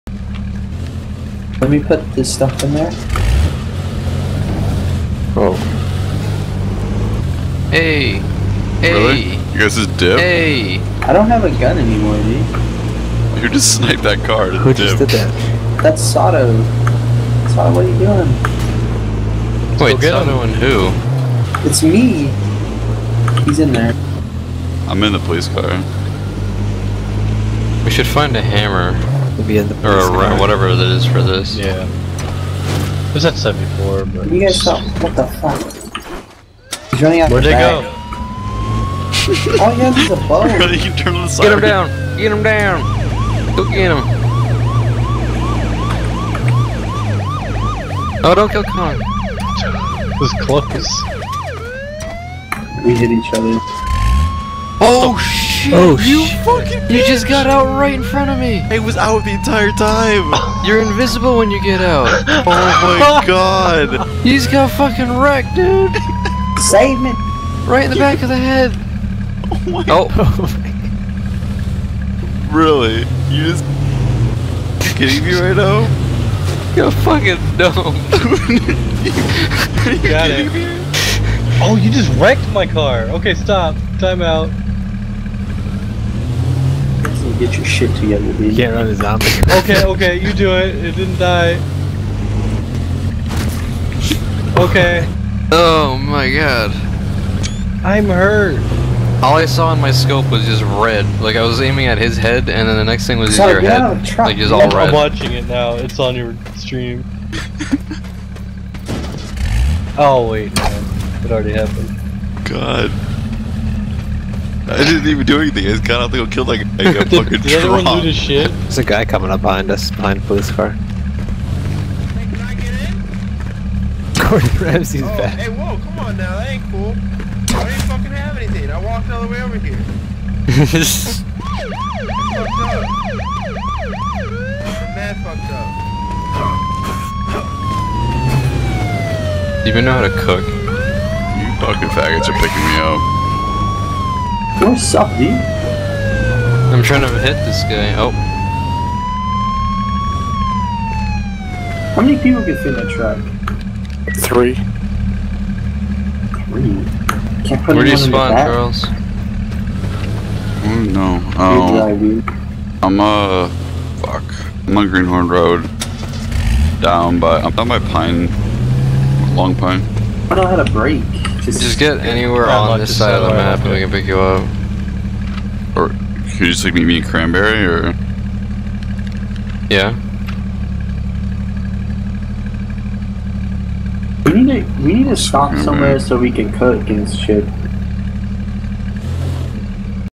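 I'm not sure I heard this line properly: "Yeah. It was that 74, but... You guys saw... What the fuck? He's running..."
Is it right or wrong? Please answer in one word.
right.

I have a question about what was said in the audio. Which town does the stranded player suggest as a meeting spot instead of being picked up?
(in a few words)
Cranberry.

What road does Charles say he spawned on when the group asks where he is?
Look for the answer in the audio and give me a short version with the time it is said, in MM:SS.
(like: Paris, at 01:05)
Greenhorn Road, at 02:44.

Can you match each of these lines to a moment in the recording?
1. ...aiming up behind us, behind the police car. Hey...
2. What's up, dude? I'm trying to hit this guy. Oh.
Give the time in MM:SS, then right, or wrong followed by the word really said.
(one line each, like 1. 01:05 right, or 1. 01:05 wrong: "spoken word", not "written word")
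1. 01:59 wrong: "coming", not "aiming"
2. 02:24 right.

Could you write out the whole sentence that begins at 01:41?
Like I was aiming at his head, and then the next thing was just your yeah, head.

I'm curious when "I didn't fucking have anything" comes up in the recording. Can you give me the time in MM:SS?
02:06.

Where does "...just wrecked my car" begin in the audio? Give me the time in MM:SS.
01:21.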